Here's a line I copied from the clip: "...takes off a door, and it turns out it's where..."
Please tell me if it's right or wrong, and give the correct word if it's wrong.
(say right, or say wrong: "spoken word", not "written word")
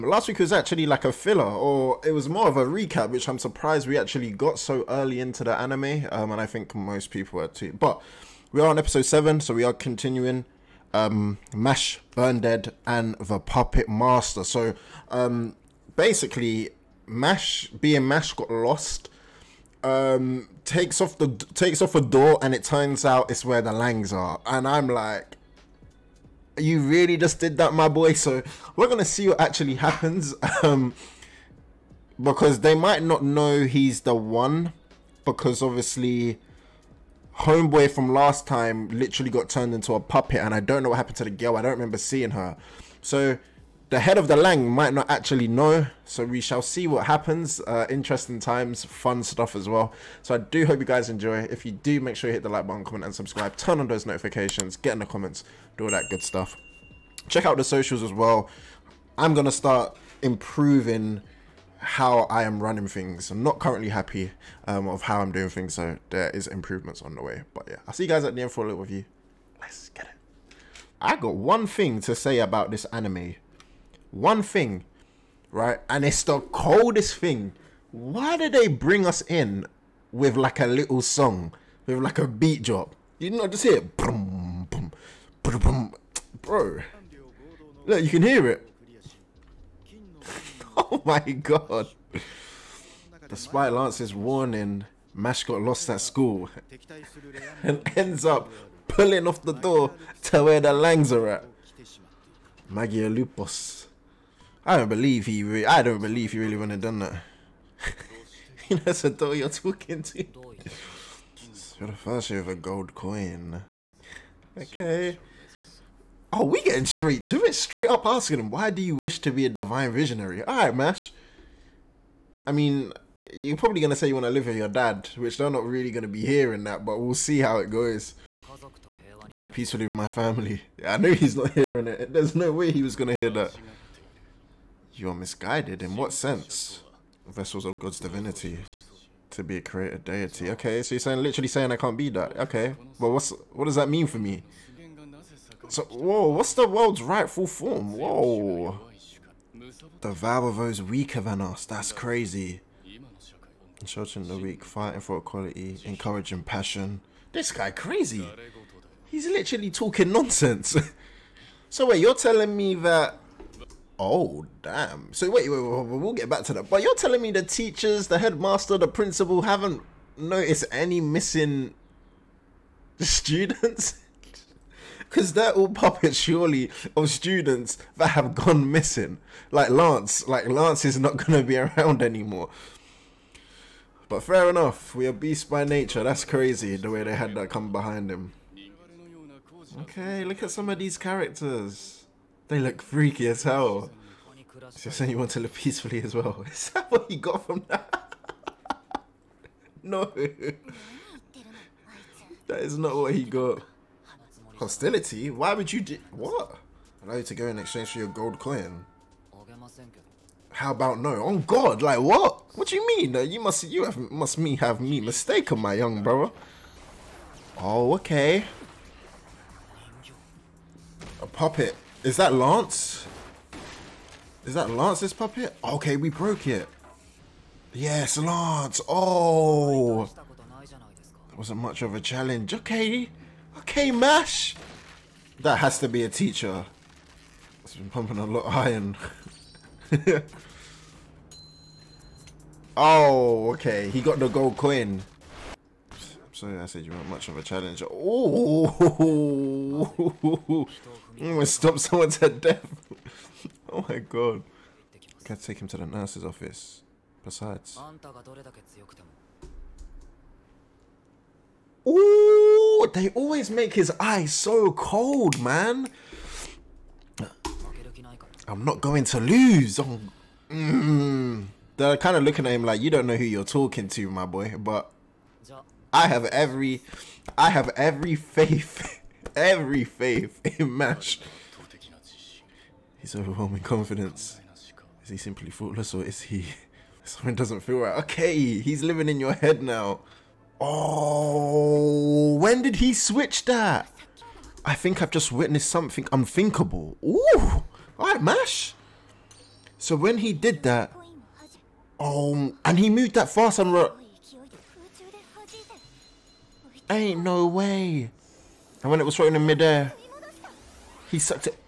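right.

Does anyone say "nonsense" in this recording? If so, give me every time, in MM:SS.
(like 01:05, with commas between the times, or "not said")
02:40.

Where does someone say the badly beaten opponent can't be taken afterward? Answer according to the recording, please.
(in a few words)
The nurse's office.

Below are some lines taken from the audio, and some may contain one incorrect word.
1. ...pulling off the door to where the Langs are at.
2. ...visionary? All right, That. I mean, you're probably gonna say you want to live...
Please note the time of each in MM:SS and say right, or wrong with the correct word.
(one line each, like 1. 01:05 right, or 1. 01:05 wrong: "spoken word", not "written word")
1. 01:38 right
2. 01:59 wrong: "Mash", not "That".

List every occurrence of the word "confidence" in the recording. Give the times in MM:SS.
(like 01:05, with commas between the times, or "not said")
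04:43.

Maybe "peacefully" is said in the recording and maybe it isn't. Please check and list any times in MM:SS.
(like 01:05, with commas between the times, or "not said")
02:09, 03:15.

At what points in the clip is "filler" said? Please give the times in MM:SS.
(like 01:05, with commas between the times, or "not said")
00:01.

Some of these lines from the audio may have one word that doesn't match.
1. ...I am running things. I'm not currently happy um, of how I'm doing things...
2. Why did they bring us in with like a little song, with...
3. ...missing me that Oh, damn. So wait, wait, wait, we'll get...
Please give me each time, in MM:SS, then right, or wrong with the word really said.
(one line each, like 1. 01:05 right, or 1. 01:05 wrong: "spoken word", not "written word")
1. 01:02 right
2. 01:17 right
3. 02:42 wrong: "telling", not "missing".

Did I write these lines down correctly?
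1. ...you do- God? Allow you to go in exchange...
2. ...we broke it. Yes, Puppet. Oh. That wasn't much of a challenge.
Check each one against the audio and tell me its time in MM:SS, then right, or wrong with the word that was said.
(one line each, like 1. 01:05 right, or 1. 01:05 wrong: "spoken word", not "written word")
1. 03:25 wrong: "What", not "God"
2. 03:45 wrong: "Lance", not "Puppet".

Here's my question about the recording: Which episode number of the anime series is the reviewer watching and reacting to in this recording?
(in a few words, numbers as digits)
7.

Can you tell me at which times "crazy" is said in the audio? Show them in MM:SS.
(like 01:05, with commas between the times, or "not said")
02:31, 02:37, 03:06.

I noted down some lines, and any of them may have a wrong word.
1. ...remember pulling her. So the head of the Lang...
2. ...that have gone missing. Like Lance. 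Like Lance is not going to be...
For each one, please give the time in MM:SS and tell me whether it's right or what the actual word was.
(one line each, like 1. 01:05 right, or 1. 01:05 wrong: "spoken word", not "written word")
1. 00:41 wrong: "seeing", not "pulling"
2. 02:57 right.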